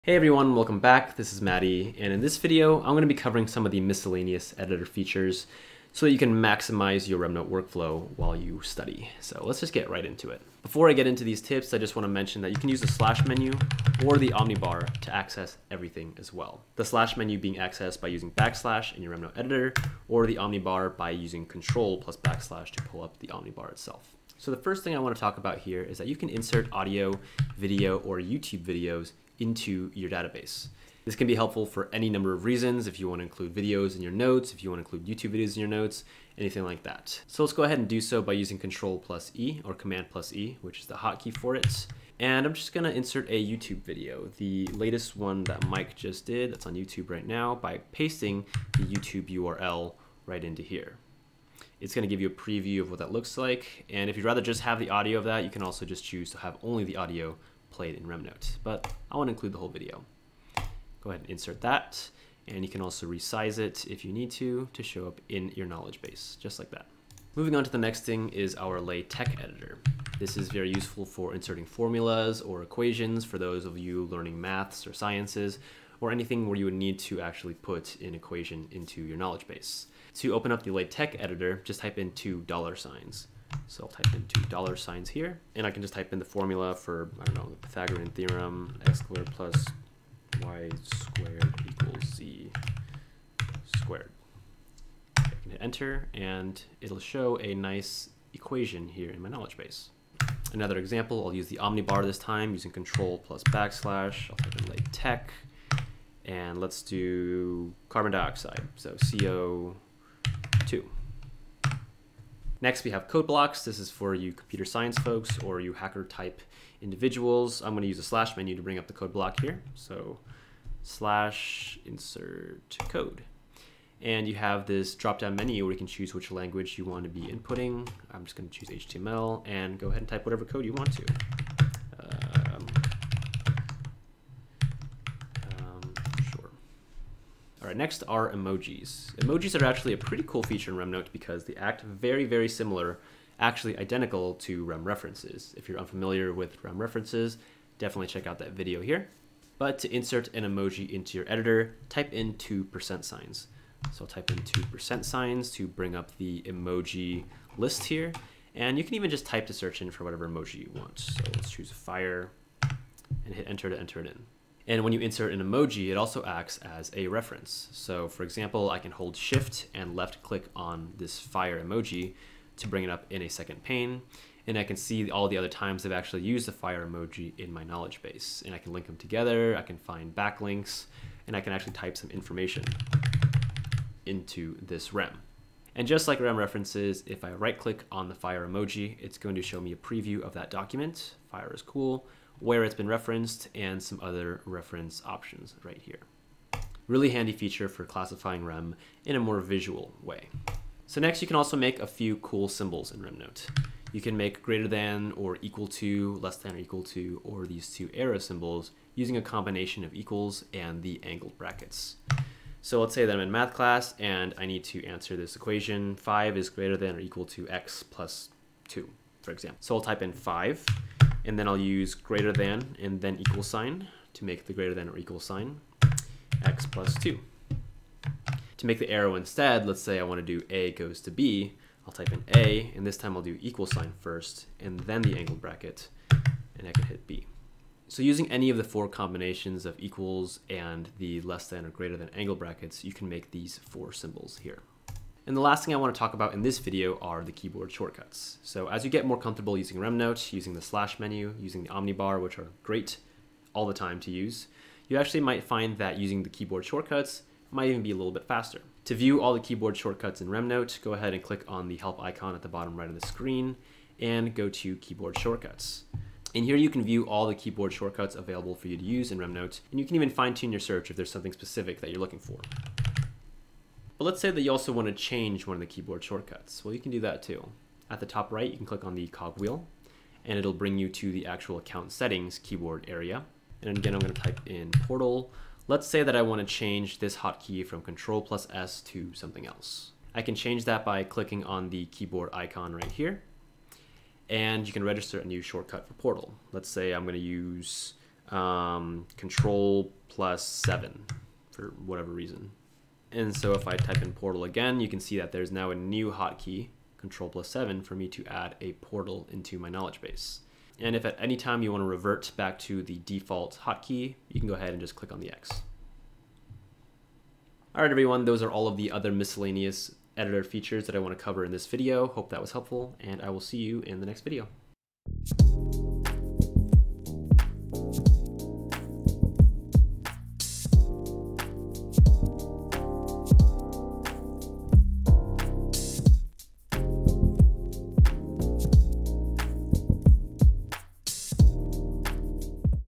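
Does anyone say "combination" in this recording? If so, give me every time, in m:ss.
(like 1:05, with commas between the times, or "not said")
3:29, 3:58.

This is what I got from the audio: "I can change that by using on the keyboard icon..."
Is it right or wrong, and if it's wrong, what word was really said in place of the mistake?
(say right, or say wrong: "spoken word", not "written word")
wrong: "clicking", not "using".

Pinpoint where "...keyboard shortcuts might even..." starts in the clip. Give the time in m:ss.
4:16.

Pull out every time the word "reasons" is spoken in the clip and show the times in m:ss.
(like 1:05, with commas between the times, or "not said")
0:32, 5:02.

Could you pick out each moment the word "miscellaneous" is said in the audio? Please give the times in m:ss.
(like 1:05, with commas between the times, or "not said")
0:03, 5:19.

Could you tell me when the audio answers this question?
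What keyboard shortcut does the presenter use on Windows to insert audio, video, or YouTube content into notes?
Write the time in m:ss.
0:38.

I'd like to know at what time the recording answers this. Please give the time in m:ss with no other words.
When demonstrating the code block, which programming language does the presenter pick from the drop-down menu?
2:08.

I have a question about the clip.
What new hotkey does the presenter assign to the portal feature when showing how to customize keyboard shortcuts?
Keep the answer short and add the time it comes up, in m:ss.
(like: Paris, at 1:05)
control plus 7, at 4:59.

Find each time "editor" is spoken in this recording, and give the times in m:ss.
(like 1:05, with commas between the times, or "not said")
0:04, 0:19, 1:09, 1:21, 2:31, 5:20.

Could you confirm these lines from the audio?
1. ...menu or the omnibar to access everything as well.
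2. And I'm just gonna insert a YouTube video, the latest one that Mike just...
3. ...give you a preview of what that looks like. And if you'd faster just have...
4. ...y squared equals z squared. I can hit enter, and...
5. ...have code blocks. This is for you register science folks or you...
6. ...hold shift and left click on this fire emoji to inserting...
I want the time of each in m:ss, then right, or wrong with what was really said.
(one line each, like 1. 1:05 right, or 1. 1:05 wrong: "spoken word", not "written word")
1. 0:13 right
2. 0:42 right
3. 0:52 wrong: "rather", not "faster"
4. 1:30 right
5. 1:52 wrong: "computer", not "register"
6. 2:48 wrong: "bring", not "inserting".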